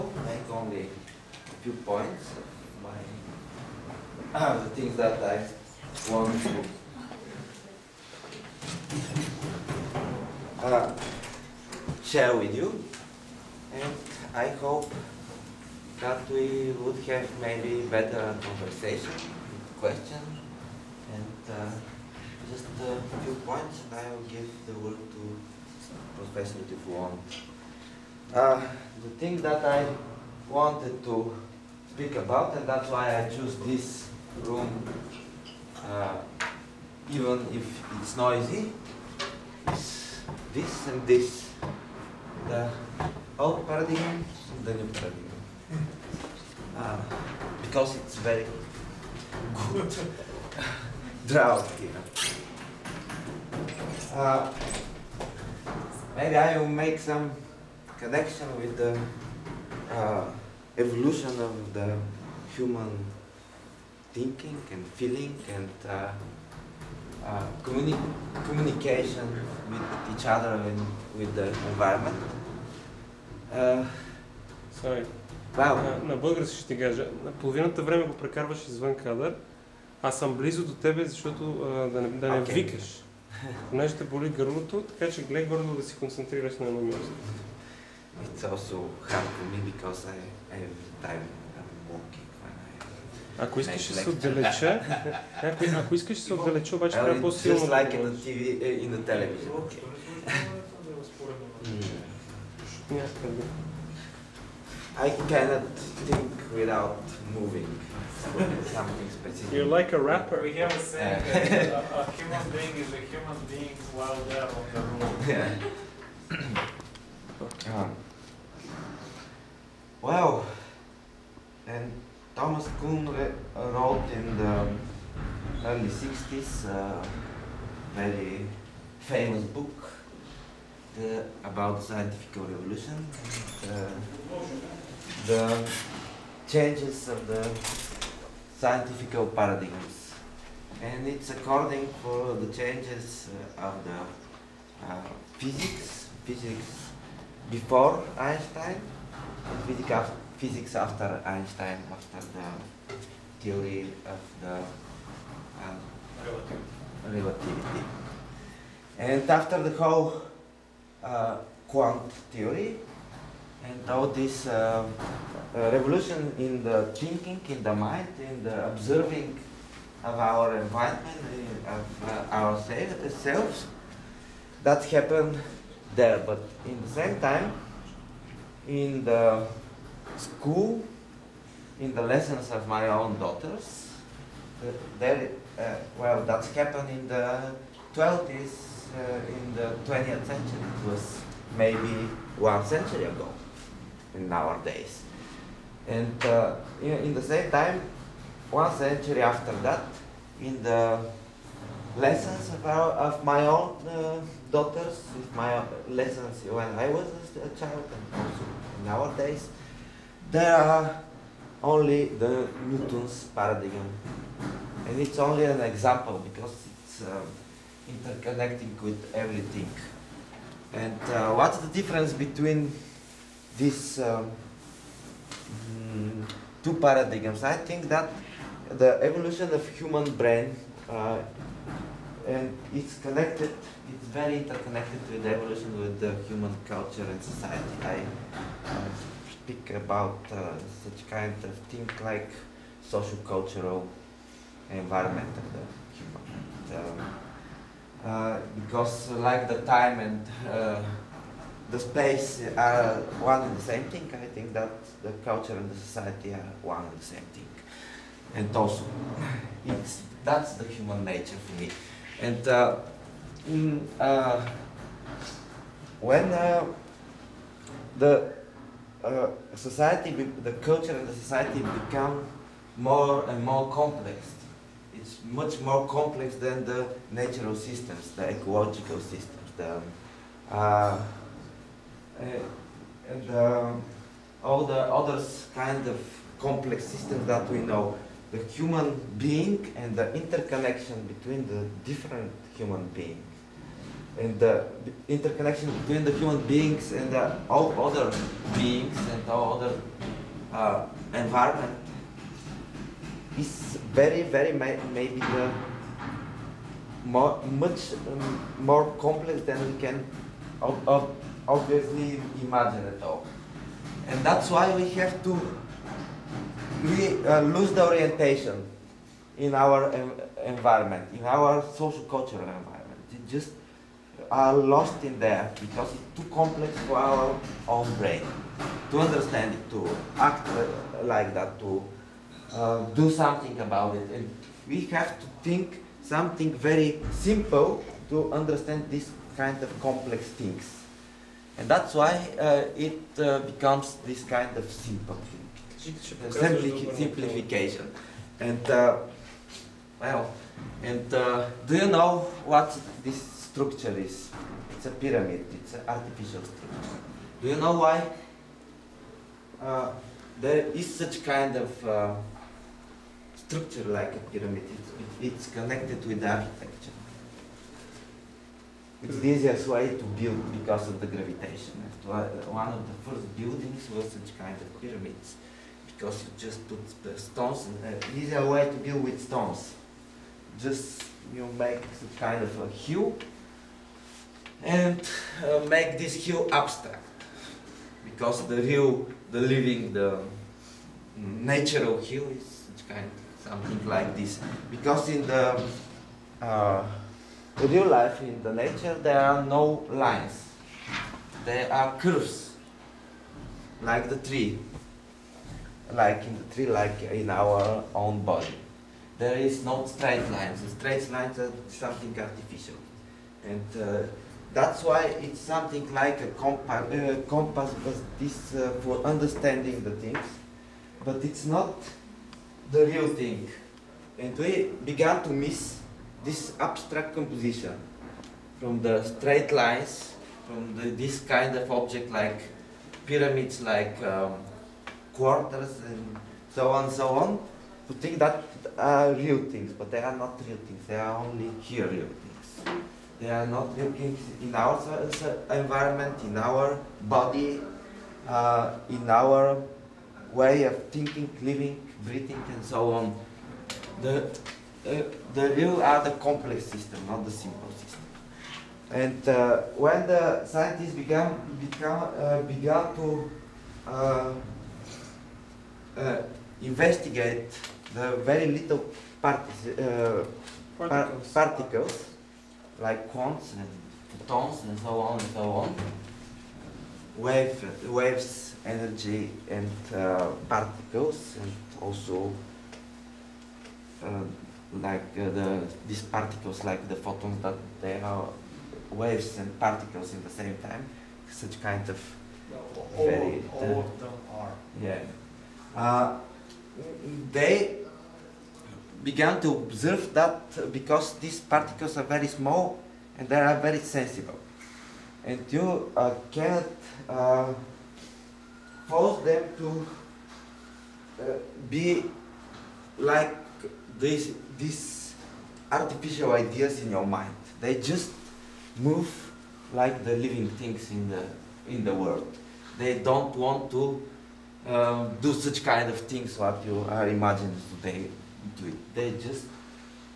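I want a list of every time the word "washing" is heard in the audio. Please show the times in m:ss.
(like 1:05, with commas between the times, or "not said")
not said.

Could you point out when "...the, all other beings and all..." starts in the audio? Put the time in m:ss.
4:57.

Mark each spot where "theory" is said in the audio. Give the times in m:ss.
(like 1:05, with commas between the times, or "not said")
2:33, 2:42.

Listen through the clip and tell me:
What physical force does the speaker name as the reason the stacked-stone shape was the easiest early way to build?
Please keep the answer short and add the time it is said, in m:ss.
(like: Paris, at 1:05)
Gravitation, at 6:11.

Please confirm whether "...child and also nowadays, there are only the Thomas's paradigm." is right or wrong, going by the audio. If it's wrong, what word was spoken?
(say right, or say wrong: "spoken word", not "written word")
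wrong: "Newton", not "Thomas".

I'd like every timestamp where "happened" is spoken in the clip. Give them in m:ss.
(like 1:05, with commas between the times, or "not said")
2:54, 3:06.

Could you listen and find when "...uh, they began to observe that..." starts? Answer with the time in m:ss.
8:15.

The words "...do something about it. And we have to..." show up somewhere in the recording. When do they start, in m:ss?
5:32.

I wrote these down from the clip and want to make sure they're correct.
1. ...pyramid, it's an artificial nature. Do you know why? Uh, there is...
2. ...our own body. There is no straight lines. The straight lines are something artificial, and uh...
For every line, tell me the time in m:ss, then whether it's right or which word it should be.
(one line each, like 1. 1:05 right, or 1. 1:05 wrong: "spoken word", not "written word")
1. 5:54 wrong: "structure", not "nature"
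2. 6:47 right.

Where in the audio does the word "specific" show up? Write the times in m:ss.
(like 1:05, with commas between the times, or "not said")
1:49.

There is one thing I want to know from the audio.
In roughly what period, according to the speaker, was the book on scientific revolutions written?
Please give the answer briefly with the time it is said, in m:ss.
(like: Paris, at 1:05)
early 60s, at 2:05.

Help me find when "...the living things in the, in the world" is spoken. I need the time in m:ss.
8:40.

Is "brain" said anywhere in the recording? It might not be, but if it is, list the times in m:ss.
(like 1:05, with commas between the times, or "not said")
3:50, 5:27.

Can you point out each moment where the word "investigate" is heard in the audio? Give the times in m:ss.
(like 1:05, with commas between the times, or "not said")
7:46.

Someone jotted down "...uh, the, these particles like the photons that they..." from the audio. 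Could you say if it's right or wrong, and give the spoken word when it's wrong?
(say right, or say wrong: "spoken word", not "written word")
right.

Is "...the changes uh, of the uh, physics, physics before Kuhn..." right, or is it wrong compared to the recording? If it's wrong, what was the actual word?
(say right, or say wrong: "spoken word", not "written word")
wrong: "Einstein", not "Kuhn".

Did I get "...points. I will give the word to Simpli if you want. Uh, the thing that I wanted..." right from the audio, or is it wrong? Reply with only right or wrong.
wrong.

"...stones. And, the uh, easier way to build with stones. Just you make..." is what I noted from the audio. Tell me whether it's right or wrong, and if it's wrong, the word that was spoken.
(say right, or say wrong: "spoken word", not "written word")
right.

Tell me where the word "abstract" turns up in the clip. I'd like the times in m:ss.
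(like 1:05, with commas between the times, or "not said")
6:26, 7:06.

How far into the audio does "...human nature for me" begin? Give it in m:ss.
4:20.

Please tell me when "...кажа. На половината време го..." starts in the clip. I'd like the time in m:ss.
1:16.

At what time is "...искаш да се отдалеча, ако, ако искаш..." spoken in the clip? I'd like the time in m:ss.
1:33.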